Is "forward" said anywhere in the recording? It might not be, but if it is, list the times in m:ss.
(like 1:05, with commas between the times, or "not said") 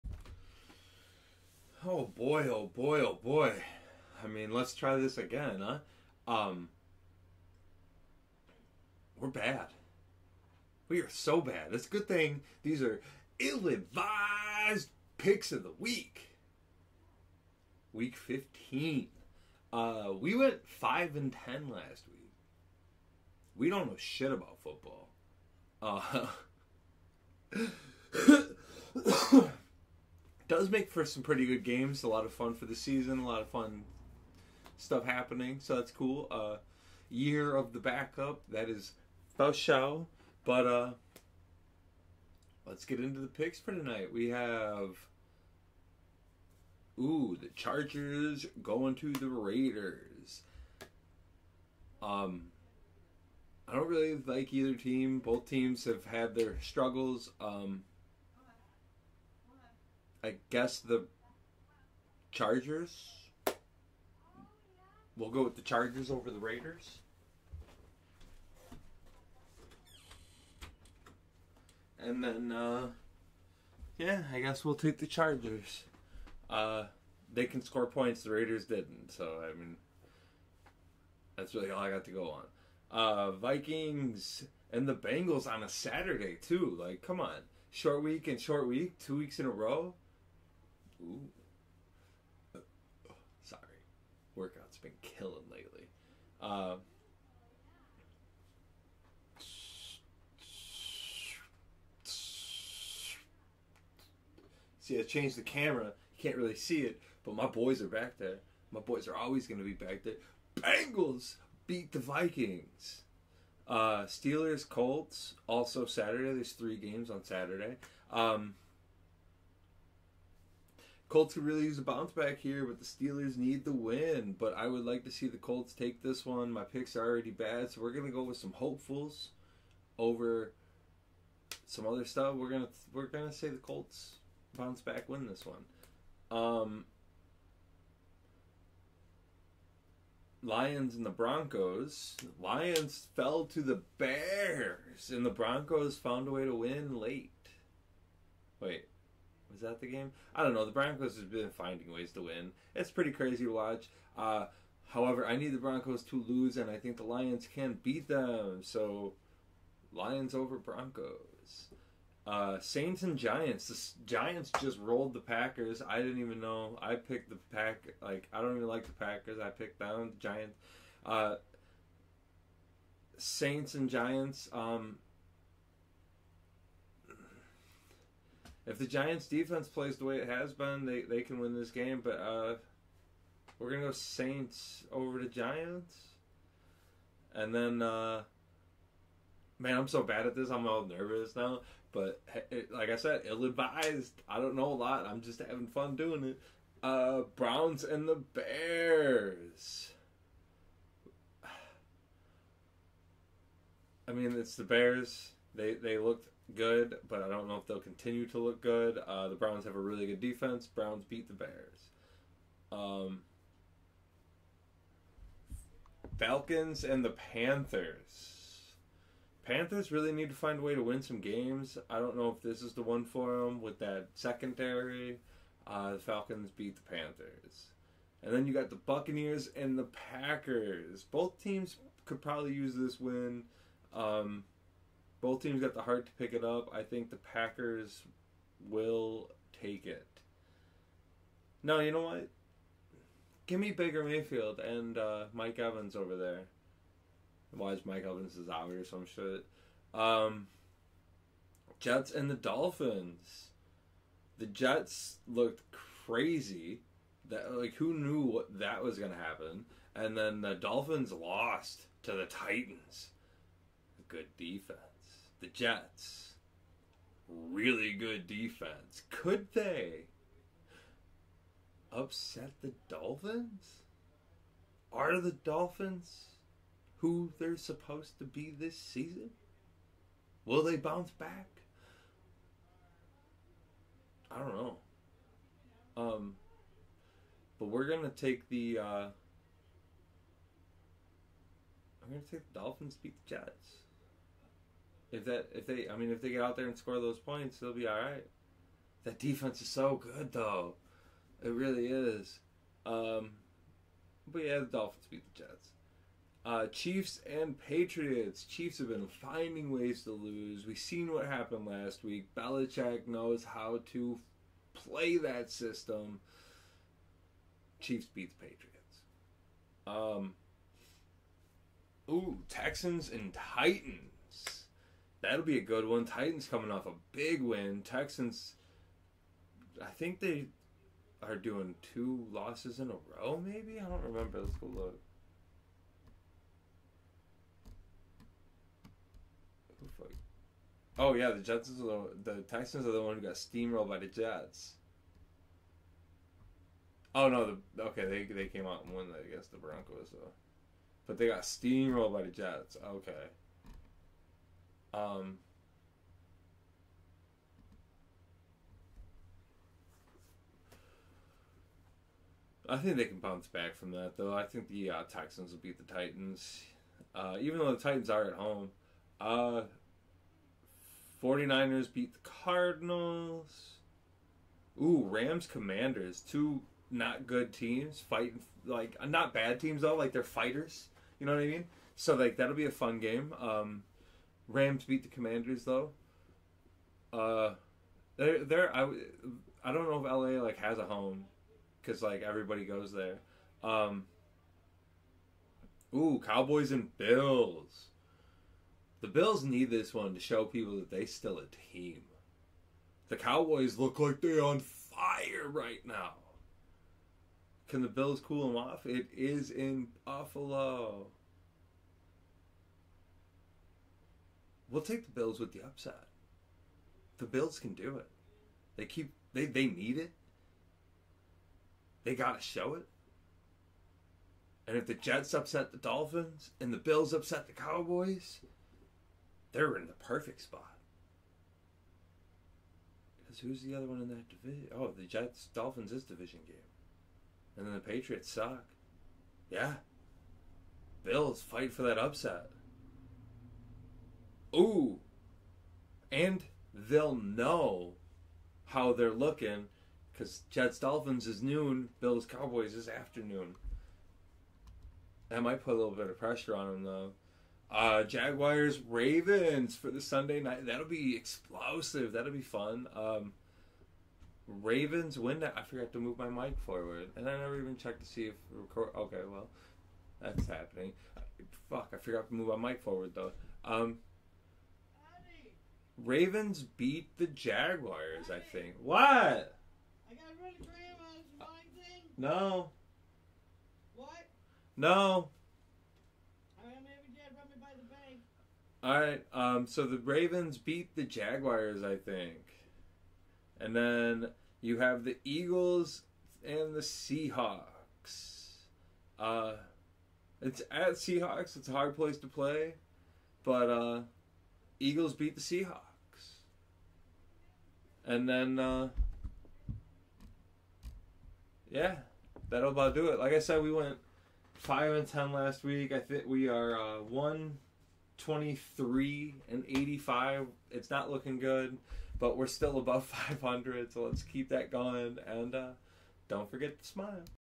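7:46, 7:52.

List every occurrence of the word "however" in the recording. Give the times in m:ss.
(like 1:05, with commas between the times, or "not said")
2:34.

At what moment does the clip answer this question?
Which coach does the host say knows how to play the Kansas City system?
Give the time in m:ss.
5:12.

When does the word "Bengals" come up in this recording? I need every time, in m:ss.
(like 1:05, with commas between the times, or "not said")
1:24, 1:50.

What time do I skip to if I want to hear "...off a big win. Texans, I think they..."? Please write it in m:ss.
5:26.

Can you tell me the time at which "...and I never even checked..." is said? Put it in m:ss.
7:47.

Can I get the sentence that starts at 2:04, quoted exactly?
But I would like to see the Colts take this one.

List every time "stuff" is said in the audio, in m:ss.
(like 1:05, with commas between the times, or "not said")
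0:34, 2:12.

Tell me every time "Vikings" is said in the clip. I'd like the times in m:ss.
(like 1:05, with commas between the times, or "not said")
1:23, 1:51.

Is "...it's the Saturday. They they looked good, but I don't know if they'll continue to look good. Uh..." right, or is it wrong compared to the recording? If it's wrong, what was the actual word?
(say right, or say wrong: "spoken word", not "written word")
wrong: "Bears", not "Saturday".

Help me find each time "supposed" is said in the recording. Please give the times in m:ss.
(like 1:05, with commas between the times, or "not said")
4:37.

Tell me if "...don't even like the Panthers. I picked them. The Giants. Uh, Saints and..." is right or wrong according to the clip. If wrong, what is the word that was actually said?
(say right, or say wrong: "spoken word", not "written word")
wrong: "Packers", not "Panthers".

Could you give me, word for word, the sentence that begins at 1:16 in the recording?
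Uh, they can score points, the Raiders didn't.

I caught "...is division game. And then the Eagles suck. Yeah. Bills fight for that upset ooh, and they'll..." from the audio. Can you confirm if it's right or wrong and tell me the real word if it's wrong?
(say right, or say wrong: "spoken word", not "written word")
wrong: "Patriots", not "Eagles".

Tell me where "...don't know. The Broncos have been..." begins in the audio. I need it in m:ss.
2:30.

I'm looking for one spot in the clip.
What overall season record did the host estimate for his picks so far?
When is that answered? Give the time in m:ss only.
8:37.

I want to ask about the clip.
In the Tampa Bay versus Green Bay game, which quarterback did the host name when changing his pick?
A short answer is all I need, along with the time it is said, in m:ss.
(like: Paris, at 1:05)
Baker Mayfield, at 4:03.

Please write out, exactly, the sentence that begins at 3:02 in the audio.
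But uh, we're gonna go Saints over the Giants, and then uh, man, I'm so bad at this.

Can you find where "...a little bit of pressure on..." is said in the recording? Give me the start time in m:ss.
7:35.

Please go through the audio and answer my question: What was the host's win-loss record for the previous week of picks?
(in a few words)
5 and 10.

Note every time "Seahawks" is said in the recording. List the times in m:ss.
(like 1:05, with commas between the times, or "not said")
8:16, 8:20, 8:25.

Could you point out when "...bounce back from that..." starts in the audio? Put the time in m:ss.
6:03.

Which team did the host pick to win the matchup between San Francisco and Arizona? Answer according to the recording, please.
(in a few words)
49ers.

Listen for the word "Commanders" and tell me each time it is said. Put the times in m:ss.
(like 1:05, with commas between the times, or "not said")
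6:15, 6:25.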